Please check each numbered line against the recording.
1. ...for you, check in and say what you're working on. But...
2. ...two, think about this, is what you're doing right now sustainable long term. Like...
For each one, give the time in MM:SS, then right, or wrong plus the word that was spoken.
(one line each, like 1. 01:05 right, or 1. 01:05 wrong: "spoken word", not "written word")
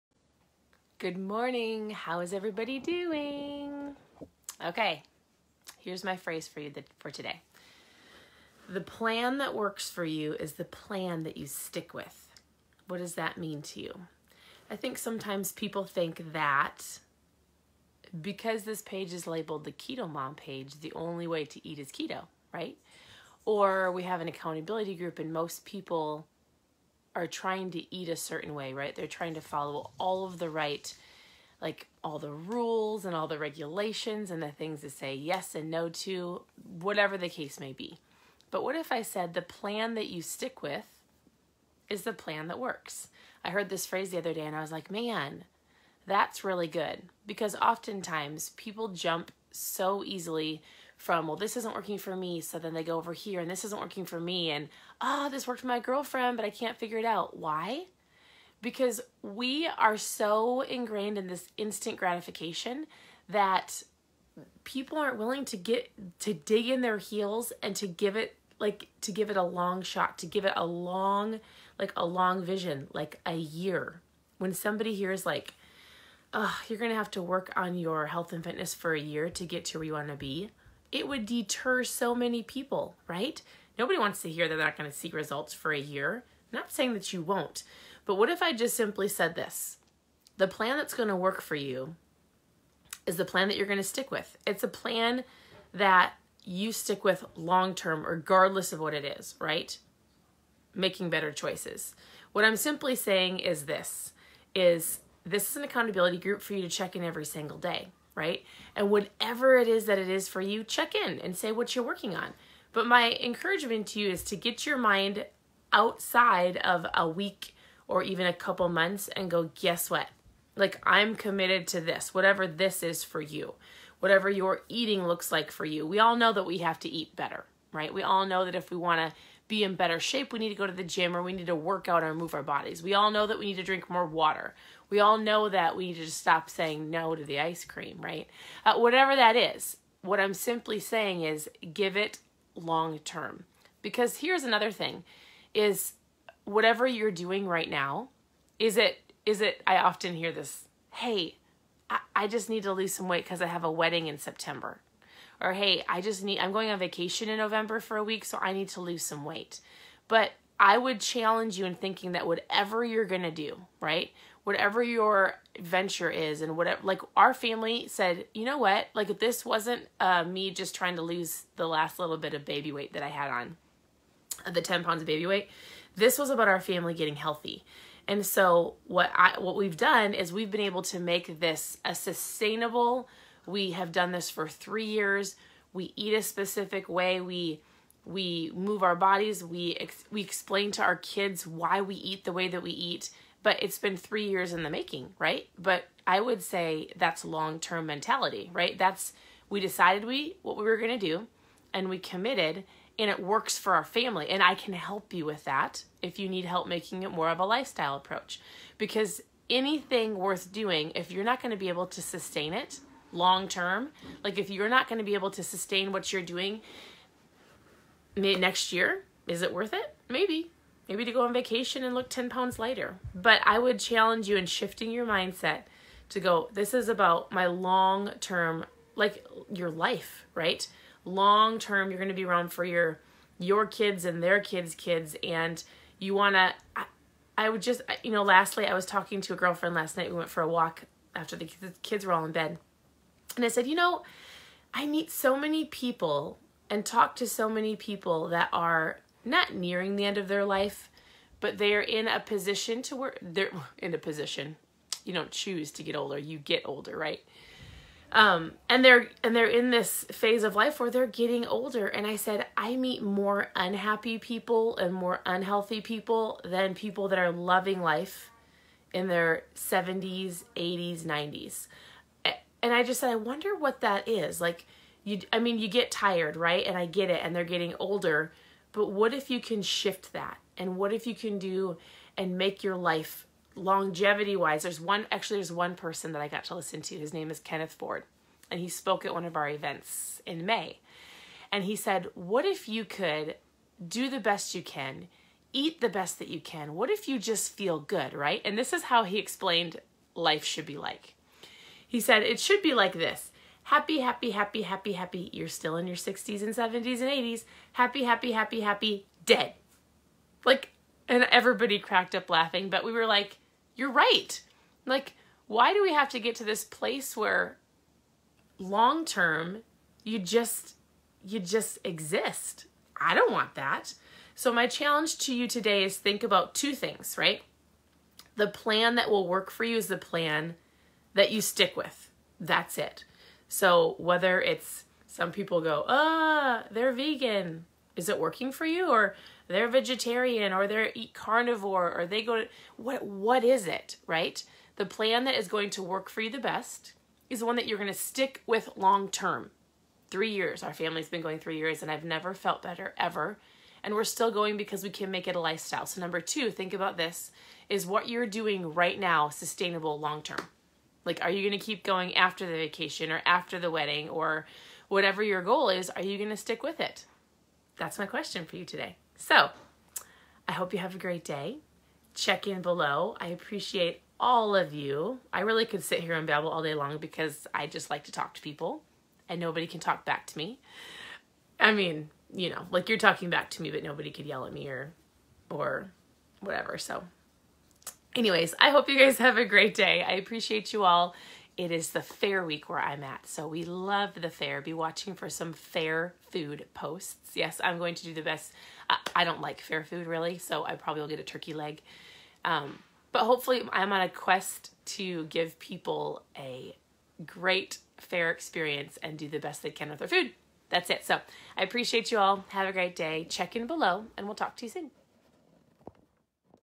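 1. 01:50 right
2. 05:56 right.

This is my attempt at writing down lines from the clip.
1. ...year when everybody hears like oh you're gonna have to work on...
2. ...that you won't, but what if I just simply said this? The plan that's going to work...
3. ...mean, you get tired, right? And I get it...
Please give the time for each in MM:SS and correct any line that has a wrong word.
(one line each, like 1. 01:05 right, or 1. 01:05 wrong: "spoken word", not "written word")
1. 01:13 wrong: "somebody", not "everybody"
2. 01:26 right
3. 04:35 right.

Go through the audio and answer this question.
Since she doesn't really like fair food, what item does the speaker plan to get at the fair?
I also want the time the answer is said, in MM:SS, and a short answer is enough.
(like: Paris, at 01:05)
turkey leg, at 06:41.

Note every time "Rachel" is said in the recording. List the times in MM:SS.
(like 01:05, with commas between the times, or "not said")
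not said.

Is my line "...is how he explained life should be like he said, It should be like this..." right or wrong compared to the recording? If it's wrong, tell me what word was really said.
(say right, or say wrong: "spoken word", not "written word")
right.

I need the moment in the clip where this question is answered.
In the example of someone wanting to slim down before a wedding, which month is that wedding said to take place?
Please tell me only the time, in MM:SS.
02:34.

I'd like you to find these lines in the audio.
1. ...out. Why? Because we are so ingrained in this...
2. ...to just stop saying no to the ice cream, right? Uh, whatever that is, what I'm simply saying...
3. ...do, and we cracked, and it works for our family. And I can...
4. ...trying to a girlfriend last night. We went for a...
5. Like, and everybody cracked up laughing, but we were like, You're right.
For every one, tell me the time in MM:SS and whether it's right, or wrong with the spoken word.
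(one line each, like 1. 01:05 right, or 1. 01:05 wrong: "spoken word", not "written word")
1. 00:57 right
2. 02:15 right
3. 03:20 wrong: "committed", not "cracked"
4. 03:58 wrong: "talking", not "trying"
5. 05:10 right.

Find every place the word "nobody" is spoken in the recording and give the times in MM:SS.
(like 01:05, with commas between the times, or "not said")
01:23, 06:19, 06:23.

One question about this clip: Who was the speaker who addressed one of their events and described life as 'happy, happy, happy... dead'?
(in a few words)
Kenneth Ford.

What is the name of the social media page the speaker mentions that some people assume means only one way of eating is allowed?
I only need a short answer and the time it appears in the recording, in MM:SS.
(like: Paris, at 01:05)
Keto Mom page, at 00:19.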